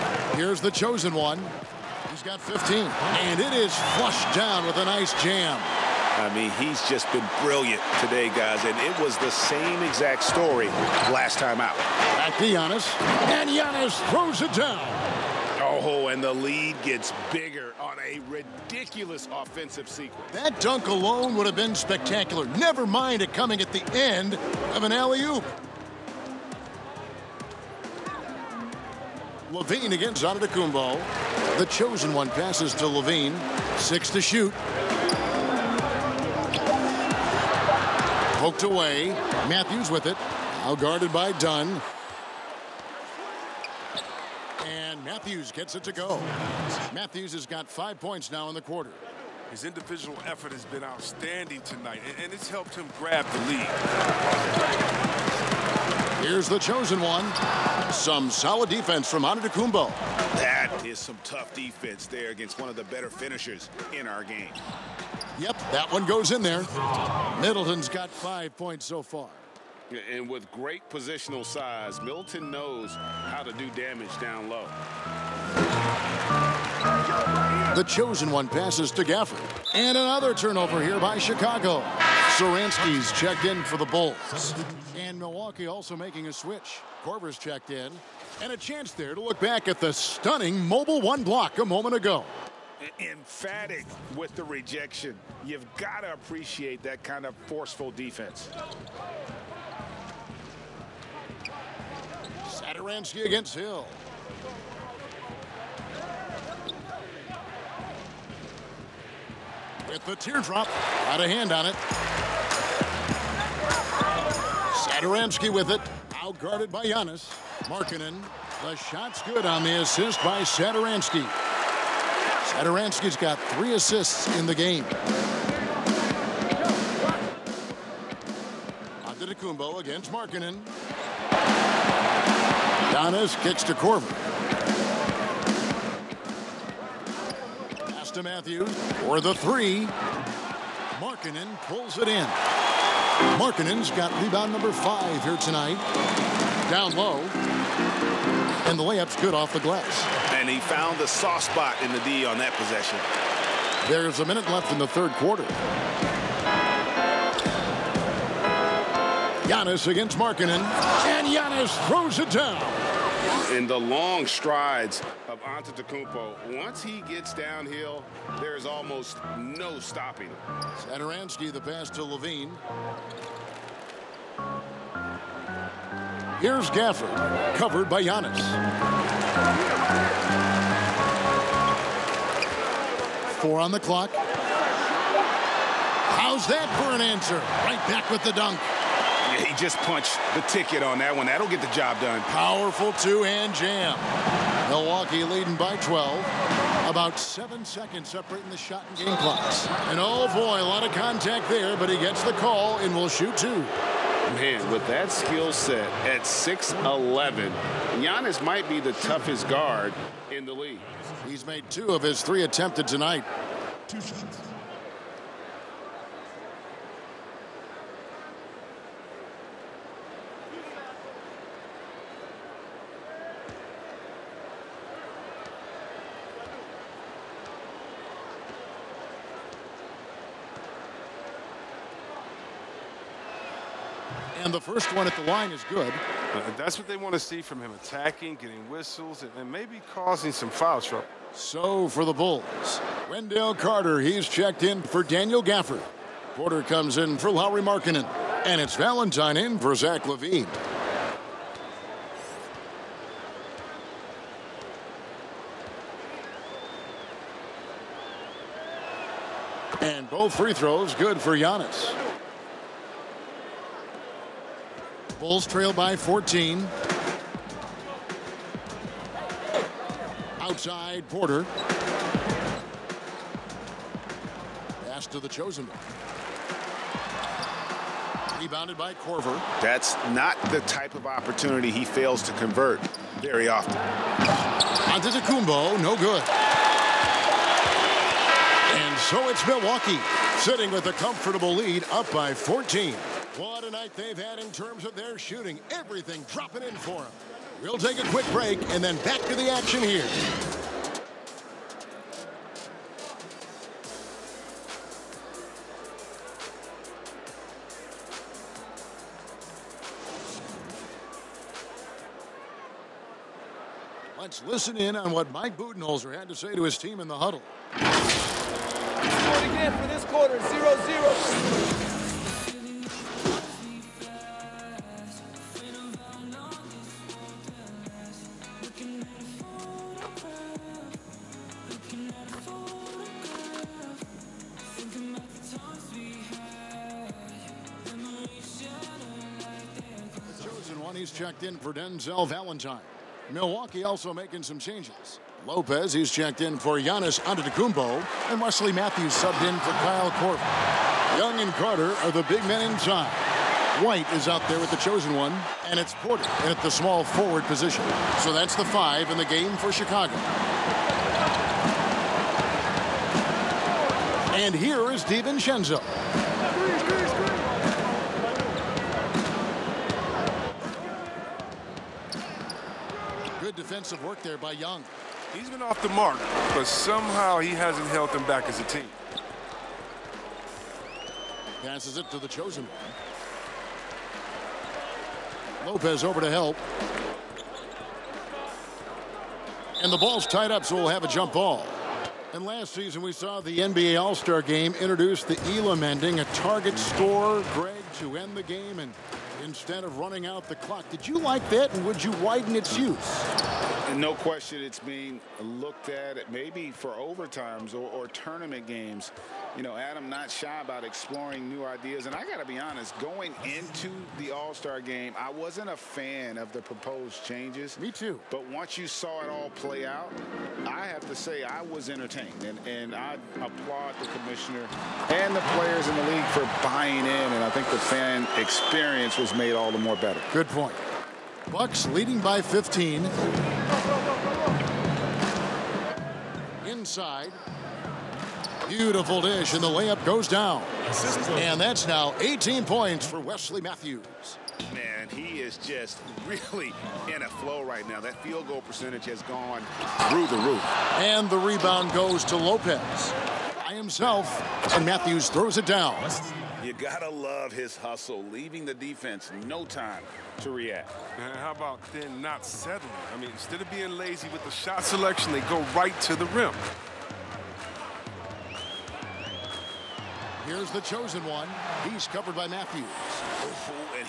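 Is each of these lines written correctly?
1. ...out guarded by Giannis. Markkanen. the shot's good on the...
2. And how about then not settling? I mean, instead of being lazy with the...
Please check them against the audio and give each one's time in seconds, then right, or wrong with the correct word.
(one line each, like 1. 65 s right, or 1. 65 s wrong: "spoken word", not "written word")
1. 116 s right
2. 461 s right.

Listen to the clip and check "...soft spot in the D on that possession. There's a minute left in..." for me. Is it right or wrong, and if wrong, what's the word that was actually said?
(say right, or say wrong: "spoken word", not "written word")
right.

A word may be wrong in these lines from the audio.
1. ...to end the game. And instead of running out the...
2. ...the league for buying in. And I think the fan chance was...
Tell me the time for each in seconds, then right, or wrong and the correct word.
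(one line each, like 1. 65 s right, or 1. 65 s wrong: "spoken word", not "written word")
1. 397 s right
2. 425 s wrong: "experience", not "chance".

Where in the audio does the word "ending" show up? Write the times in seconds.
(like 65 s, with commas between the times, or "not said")
395 s.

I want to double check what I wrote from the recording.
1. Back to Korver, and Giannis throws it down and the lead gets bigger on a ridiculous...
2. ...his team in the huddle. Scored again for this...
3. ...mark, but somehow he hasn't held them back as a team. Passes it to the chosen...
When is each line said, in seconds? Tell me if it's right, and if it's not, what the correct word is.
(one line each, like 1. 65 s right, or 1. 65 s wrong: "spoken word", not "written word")
1. 12 s wrong: "Giannis", not "Korver"
2. 316 s right
3. 375 s right.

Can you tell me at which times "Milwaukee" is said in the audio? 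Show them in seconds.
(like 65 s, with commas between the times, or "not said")
85 s, 194 s, 289 s, 343 s.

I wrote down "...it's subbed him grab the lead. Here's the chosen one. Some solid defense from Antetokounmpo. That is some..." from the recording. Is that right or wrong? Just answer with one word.
wrong.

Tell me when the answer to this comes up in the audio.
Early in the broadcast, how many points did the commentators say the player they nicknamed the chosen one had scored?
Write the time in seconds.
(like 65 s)
2 s.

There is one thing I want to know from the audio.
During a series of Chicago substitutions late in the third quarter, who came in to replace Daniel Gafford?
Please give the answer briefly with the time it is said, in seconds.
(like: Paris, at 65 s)
Wendell Carter, at 243 s.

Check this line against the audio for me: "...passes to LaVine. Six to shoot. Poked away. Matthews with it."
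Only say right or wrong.
right.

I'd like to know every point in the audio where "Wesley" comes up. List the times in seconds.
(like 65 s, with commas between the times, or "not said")
348 s, 443 s.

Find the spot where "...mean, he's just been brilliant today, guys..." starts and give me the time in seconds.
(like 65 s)
6 s.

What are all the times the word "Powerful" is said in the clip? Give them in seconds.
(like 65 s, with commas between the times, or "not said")
192 s.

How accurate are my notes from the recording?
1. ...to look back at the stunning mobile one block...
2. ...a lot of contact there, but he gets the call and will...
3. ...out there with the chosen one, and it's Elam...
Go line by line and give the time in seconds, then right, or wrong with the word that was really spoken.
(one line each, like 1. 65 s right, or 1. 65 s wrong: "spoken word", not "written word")
1. 89 s right
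2. 200 s right
3. 354 s wrong: "Porter", not "Elam".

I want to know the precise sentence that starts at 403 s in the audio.
And no question it's being looked at maybe for overtimes or, or, tournament games.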